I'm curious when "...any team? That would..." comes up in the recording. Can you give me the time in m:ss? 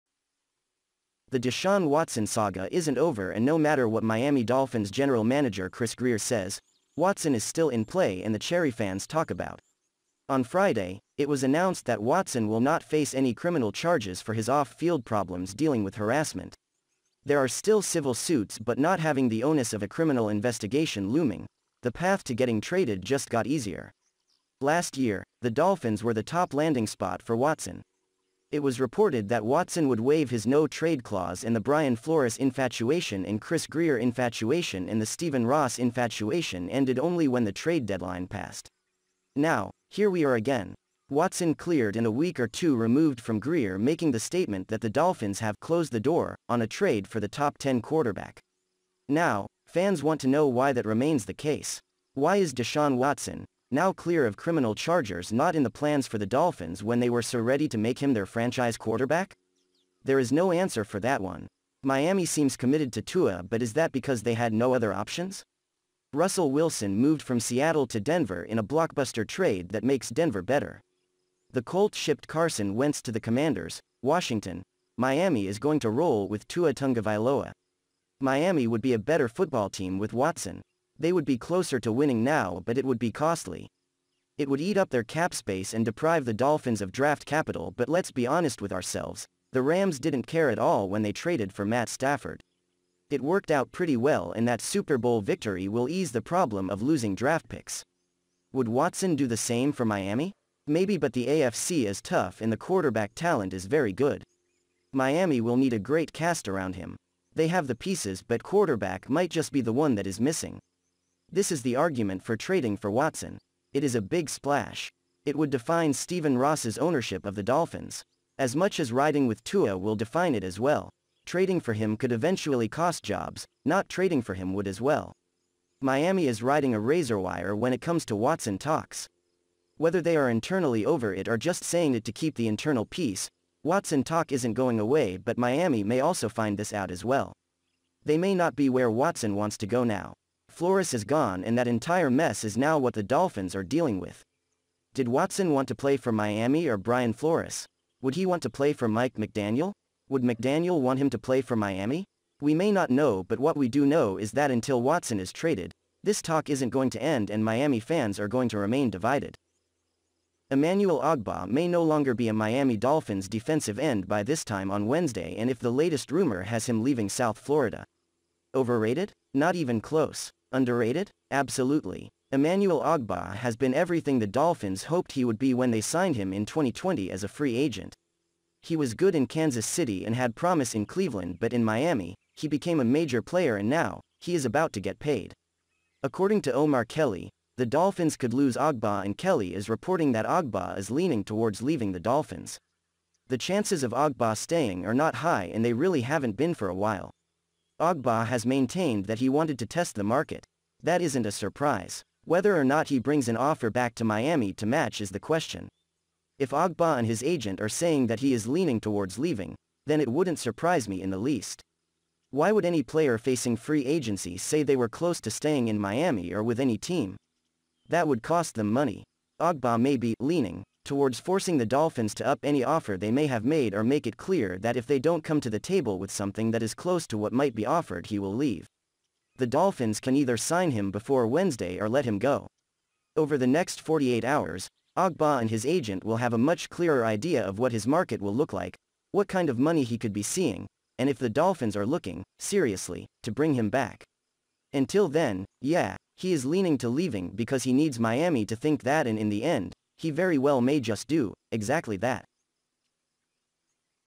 3:36.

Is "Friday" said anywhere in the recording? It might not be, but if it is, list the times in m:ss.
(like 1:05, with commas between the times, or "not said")
0:10.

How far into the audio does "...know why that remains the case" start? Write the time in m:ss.
0:50.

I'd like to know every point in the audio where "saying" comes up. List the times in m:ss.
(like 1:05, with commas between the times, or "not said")
2:11, 3:27.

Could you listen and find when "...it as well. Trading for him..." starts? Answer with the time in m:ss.
2:00.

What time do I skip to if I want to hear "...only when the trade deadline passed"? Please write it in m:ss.
0:36.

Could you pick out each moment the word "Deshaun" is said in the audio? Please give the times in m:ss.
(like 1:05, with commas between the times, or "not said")
0:01, 0:52.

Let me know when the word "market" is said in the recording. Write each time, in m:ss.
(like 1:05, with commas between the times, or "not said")
3:20, 3:57.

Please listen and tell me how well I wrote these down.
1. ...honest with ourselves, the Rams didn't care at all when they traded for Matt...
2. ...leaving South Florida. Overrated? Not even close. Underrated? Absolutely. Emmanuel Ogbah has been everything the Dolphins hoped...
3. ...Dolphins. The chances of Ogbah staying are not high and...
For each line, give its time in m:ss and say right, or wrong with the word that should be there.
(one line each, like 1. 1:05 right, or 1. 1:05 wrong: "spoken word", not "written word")
1. 1:28 right
2. 2:46 right
3. 3:11 right.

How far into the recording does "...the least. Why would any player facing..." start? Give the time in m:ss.
3:31.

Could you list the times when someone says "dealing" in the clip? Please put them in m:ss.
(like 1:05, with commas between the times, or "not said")
0:15, 2:23.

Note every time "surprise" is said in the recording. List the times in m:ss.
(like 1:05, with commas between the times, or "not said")
3:21, 3:30.